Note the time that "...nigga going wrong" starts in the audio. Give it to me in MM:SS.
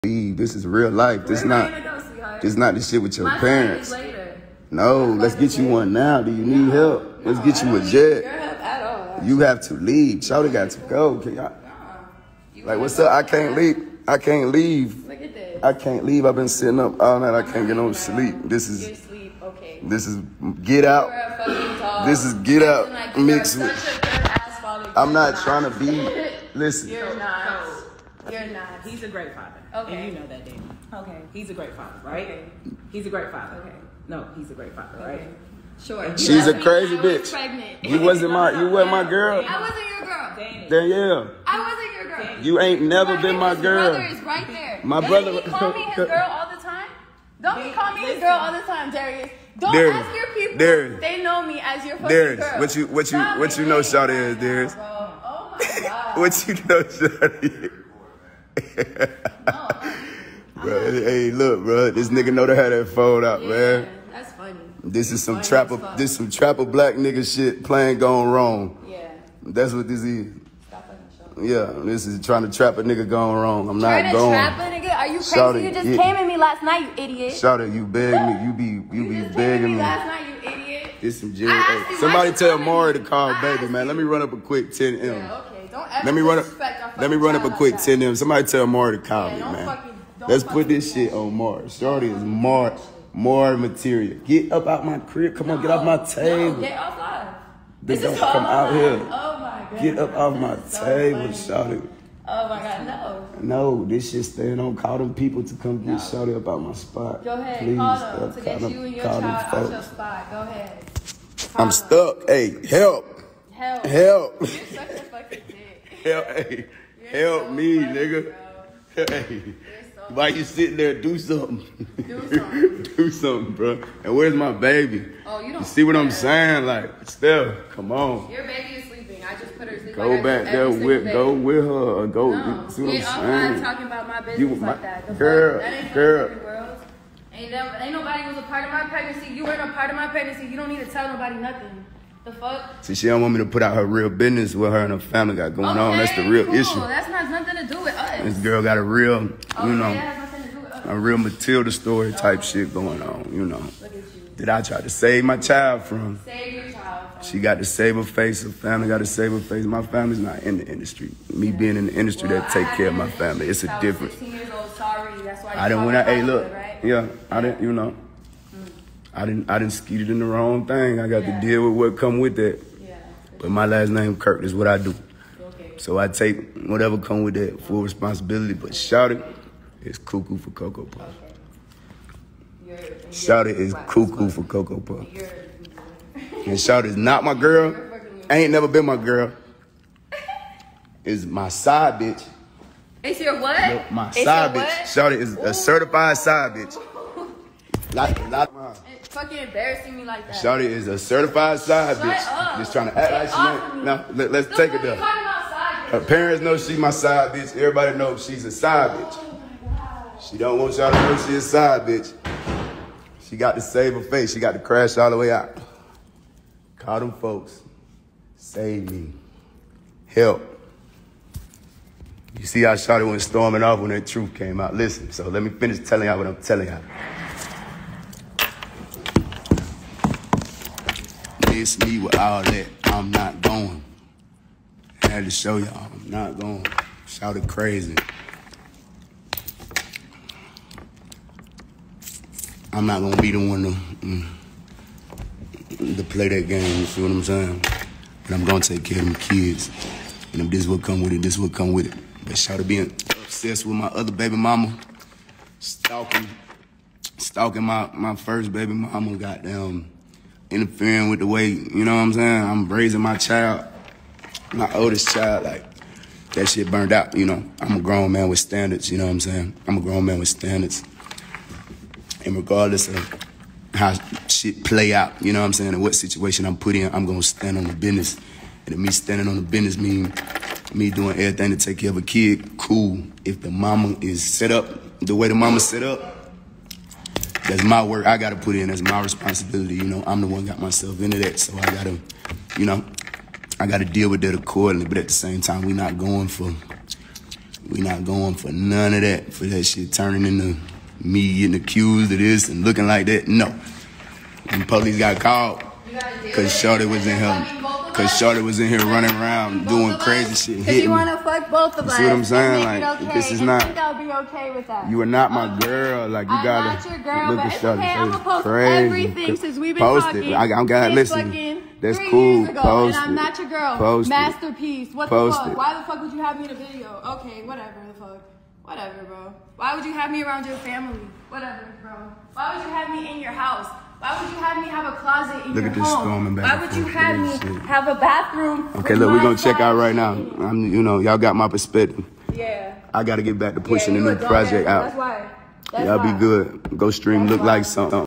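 01:12.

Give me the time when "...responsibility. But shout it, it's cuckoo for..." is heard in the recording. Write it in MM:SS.
02:57.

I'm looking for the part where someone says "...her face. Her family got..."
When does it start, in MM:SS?
02:37.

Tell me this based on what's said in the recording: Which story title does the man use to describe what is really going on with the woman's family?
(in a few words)
Matilda.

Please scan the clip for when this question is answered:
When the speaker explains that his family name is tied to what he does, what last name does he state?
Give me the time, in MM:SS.
02:54.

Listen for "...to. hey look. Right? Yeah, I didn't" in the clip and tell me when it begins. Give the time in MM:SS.
02:45.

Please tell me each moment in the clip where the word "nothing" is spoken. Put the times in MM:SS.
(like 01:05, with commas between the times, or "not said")
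02:21, 02:27.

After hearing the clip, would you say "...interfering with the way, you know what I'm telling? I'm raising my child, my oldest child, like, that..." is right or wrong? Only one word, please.
wrong.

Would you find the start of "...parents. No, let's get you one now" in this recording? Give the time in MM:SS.
00:03.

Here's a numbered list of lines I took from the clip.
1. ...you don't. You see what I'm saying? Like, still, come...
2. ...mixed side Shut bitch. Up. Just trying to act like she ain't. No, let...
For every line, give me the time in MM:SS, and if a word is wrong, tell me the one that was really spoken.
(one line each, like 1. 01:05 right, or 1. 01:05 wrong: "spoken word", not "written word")
1. 02:05 right
2. 03:20 wrong: "certified", not "mixed".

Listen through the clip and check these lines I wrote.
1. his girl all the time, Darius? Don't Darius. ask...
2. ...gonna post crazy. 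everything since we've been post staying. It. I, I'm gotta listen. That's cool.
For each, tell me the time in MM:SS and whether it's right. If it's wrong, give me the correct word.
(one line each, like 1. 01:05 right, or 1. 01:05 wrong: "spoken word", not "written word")
1. 00:48 right
2. 05:18 wrong: "talking", not "staying".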